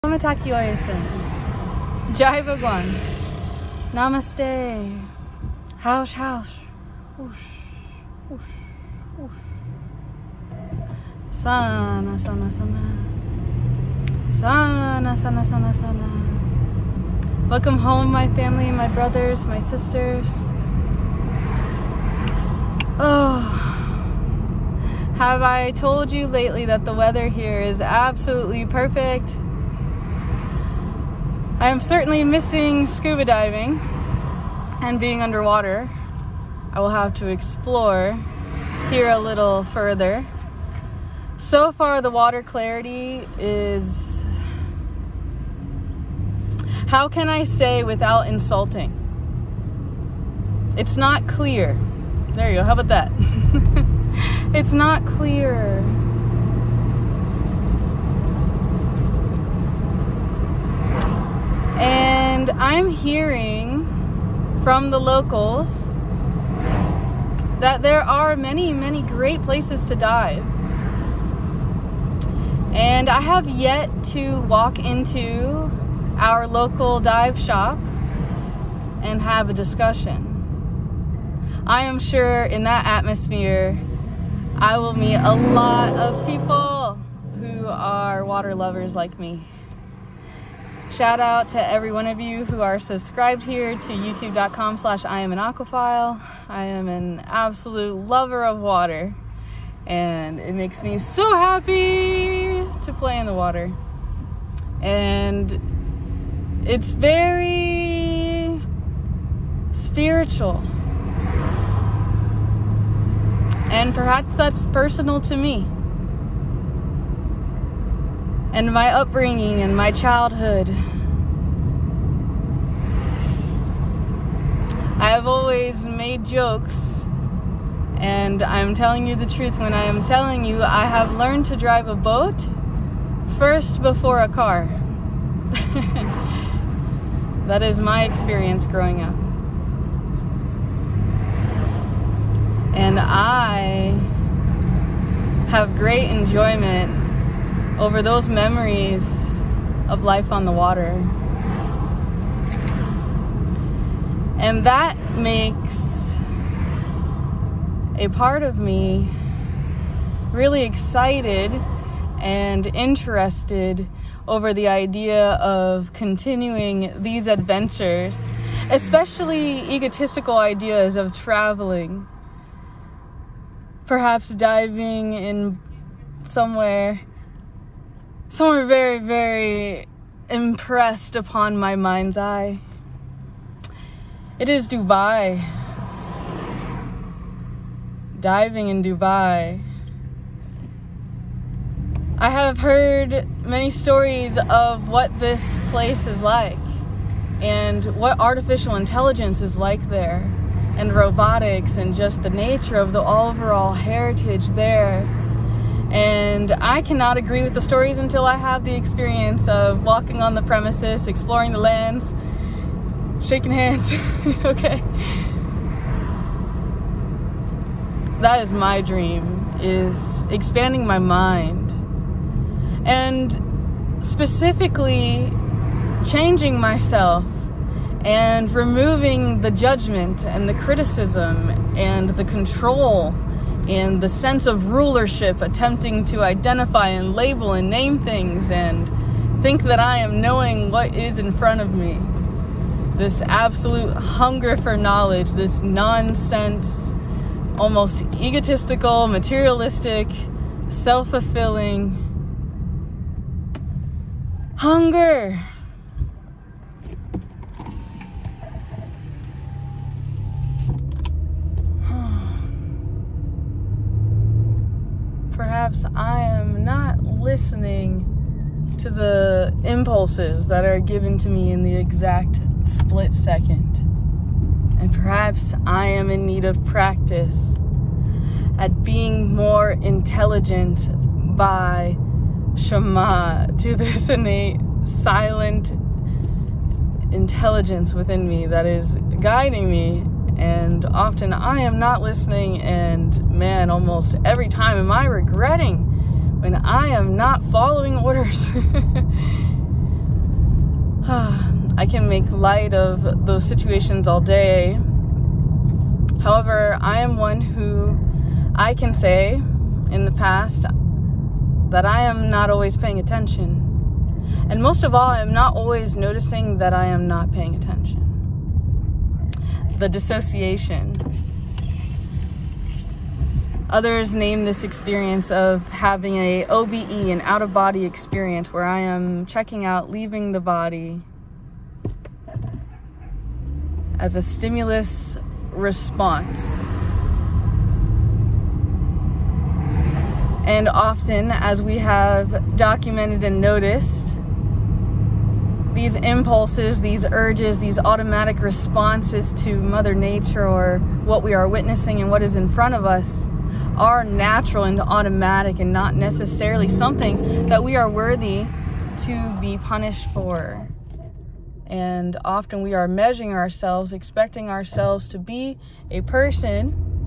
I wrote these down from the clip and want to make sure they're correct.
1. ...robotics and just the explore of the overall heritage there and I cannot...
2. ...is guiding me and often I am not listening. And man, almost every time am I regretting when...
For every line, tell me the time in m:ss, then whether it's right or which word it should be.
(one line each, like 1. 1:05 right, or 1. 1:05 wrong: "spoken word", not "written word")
1. 3:20 wrong: "nature", not "explore"
2. 4:48 right.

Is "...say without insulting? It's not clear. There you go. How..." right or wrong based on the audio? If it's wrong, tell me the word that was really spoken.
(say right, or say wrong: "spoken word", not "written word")
right.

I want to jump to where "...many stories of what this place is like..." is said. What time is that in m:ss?
3:13.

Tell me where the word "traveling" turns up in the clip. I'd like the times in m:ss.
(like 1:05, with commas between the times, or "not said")
2:51.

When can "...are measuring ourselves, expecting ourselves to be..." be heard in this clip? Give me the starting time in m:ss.
6:02.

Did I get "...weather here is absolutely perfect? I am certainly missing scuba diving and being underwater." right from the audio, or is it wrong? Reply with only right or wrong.
right.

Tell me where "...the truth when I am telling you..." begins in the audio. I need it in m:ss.
2:09.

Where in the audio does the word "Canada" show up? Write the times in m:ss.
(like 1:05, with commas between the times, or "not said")
not said.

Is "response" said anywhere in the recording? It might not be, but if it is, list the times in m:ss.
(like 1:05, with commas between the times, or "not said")
5:35, 5:48.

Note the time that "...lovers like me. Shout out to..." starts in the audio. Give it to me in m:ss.
1:28.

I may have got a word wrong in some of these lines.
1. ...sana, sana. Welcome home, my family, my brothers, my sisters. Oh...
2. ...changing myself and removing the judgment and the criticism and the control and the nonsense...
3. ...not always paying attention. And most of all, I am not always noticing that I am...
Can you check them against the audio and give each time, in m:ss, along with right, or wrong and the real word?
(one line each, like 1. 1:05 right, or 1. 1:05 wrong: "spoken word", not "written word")
1. 0:15 right
2. 3:46 wrong: "sense", not "nonsense"
3. 5:12 right.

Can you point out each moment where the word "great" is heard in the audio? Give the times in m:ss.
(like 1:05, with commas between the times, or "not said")
1:09, 2:25.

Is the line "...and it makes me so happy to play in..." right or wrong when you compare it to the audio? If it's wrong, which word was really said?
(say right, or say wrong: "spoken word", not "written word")
right.